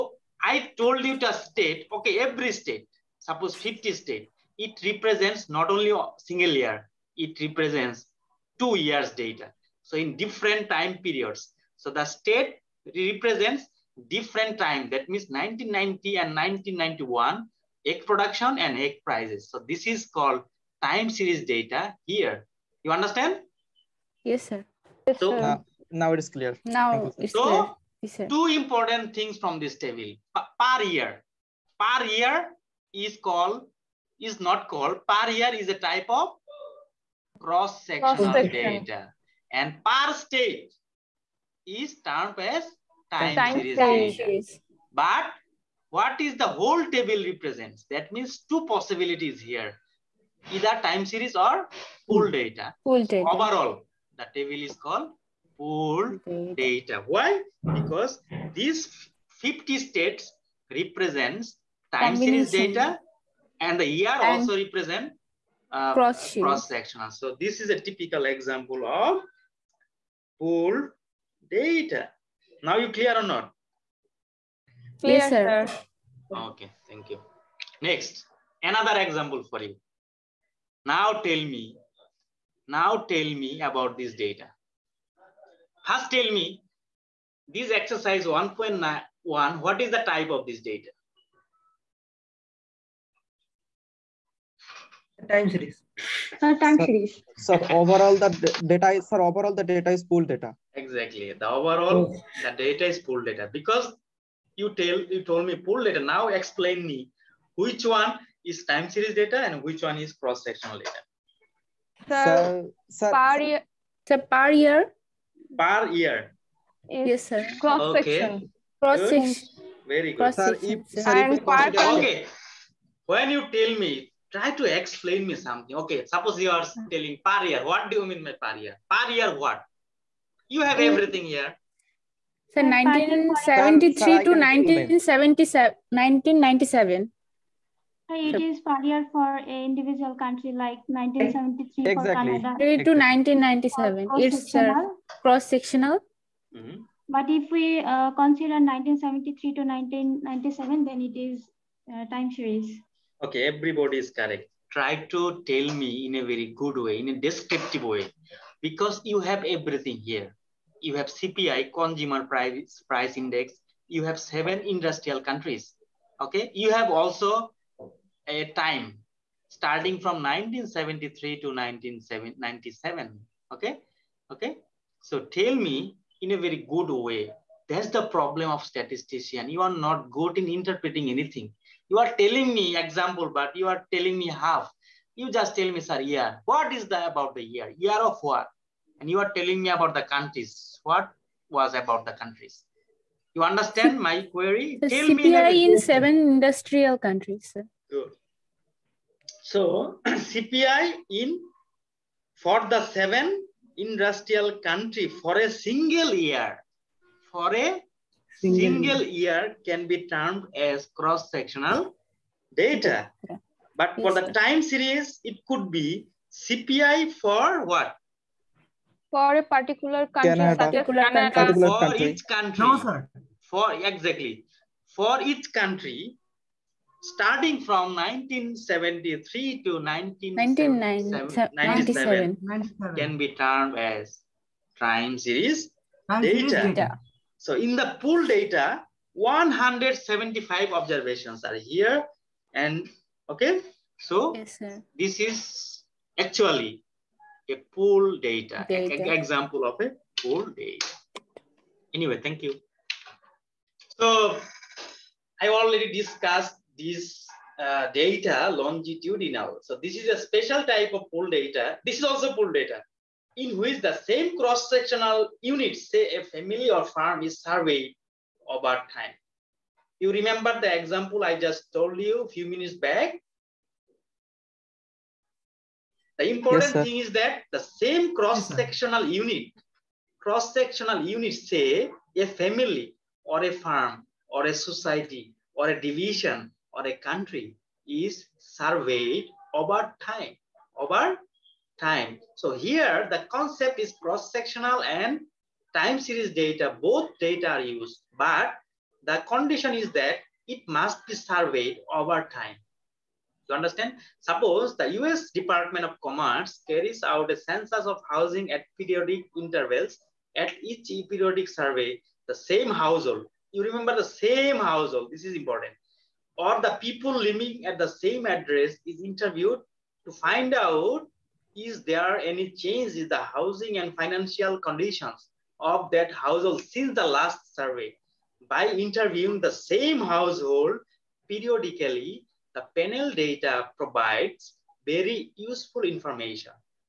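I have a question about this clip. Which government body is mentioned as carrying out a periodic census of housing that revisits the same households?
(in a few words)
US Department of Commerce.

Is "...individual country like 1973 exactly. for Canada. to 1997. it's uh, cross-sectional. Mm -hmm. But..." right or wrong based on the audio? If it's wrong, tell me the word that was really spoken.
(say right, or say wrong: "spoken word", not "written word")
right.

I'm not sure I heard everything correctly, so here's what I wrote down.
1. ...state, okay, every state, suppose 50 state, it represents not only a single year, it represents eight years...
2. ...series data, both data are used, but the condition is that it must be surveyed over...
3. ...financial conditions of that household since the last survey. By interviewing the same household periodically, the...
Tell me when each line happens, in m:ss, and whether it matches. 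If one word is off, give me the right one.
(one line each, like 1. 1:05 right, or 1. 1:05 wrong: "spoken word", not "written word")
1. 0:01 wrong: "two", not "eight"
2. 4:55 right
3. 5:23 right.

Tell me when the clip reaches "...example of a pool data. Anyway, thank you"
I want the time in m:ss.
4:09.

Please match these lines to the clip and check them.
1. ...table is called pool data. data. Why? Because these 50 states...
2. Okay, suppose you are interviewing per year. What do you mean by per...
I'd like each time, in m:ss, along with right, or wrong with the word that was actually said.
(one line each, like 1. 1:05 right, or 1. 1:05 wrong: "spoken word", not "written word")
1. 0:54 right
2. 2:05 wrong: "telling", not "interviewing".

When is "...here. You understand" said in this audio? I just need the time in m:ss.
0:22.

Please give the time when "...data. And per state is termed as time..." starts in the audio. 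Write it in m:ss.
0:38.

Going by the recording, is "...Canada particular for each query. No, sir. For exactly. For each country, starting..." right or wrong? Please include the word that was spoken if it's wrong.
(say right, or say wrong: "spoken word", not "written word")
wrong: "country", not "query".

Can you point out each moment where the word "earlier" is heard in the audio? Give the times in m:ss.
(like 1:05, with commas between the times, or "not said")
2:18.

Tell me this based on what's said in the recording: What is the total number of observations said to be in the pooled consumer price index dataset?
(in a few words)
175.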